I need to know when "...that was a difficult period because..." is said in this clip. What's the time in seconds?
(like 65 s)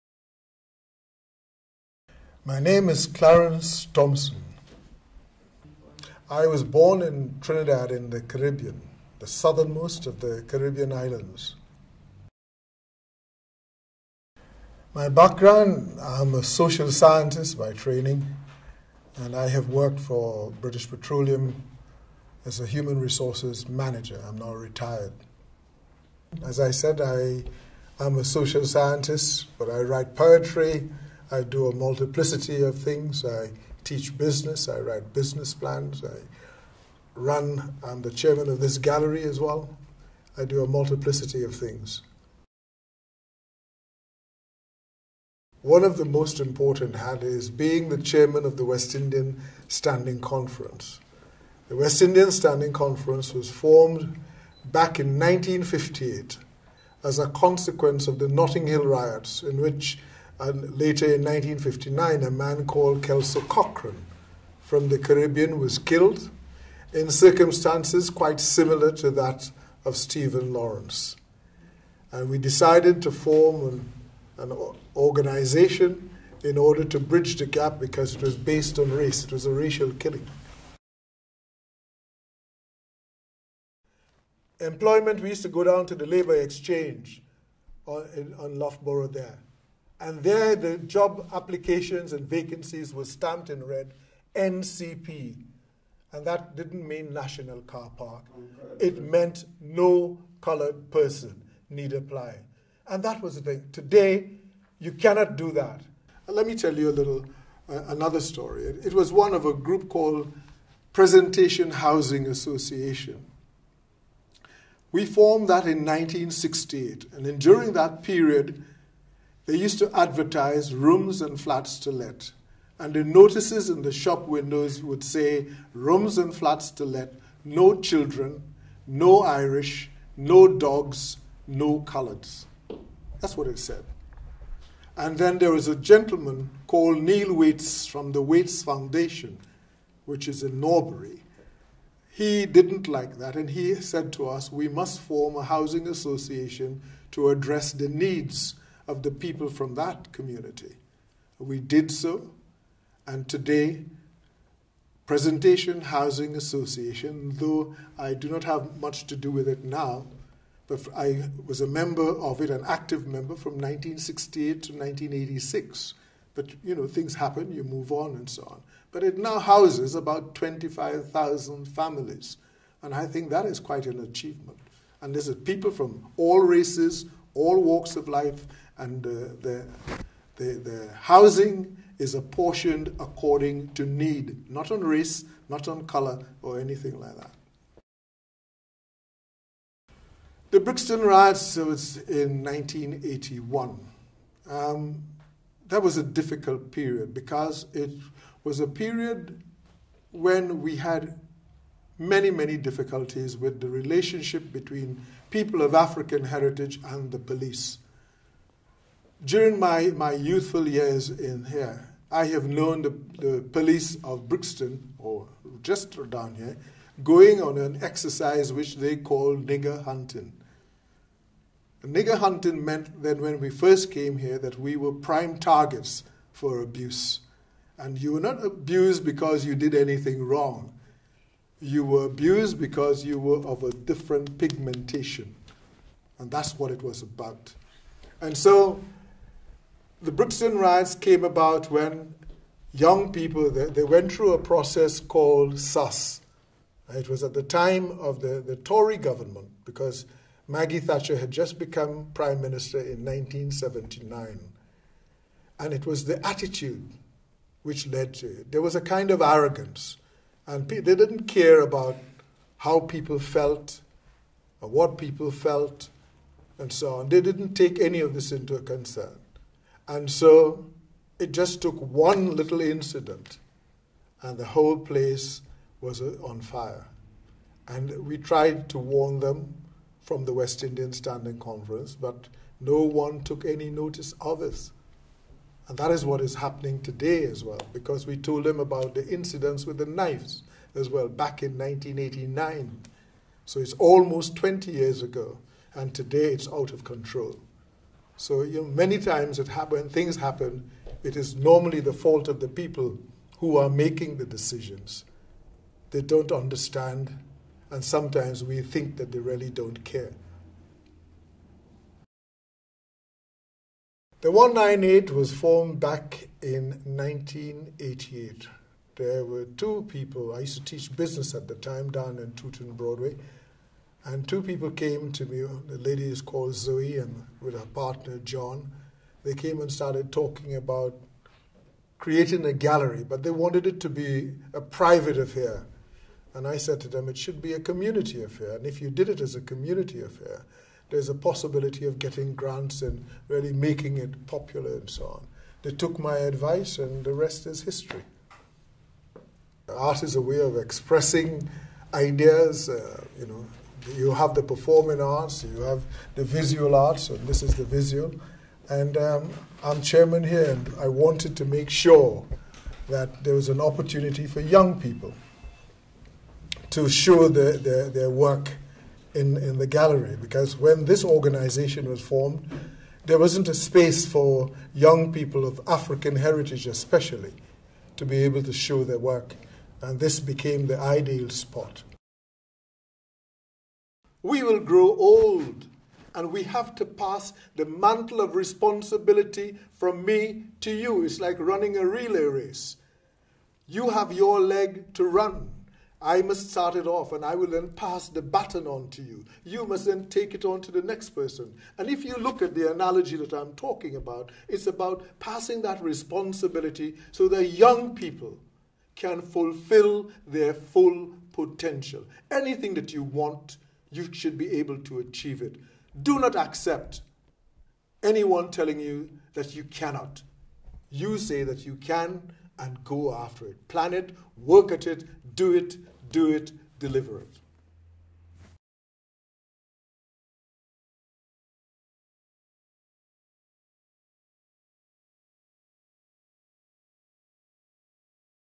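195 s.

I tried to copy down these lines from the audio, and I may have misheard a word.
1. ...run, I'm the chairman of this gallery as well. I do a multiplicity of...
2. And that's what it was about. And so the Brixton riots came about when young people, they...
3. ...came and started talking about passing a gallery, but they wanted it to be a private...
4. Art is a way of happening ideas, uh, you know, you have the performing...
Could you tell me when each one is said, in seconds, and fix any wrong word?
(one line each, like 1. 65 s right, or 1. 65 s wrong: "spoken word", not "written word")
1. 37 s right
2. 236 s right
3. 329 s wrong: "creating", not "passing"
4. 349 s wrong: "expressing", not "happening".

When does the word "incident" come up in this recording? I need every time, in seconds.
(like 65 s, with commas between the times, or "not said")
272 s, 289 s.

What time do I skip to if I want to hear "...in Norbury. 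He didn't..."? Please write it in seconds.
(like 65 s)
140 s.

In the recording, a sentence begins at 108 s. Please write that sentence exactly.
It, was one of a group called Presentation Housing Association.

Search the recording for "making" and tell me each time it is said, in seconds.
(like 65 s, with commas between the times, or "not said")
303 s, 343 s.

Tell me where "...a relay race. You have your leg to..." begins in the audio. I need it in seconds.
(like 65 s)
391 s.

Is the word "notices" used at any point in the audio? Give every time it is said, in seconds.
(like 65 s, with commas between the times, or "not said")
123 s, 283 s.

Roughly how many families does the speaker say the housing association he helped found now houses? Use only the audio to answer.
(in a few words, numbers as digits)
25,000.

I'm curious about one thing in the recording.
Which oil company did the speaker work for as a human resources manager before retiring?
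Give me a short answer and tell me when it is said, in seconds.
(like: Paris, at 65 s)
British Petroleum, at 20 s.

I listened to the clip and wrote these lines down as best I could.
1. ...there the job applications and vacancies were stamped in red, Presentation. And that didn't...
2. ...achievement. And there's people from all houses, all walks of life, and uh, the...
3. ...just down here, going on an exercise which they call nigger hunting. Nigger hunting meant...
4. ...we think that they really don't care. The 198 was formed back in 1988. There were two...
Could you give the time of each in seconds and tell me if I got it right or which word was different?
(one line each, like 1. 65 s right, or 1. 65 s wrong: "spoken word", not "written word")
1. 90 s wrong: "NCP", not "Presentation"
2. 174 s wrong: "races", not "houses"
3. 215 s right
4. 308 s right.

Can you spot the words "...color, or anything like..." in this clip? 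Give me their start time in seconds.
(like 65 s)
185 s.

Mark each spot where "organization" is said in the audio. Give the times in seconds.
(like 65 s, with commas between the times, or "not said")
74 s, 371 s.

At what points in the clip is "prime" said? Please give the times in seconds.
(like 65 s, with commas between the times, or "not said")
224 s, 252 s.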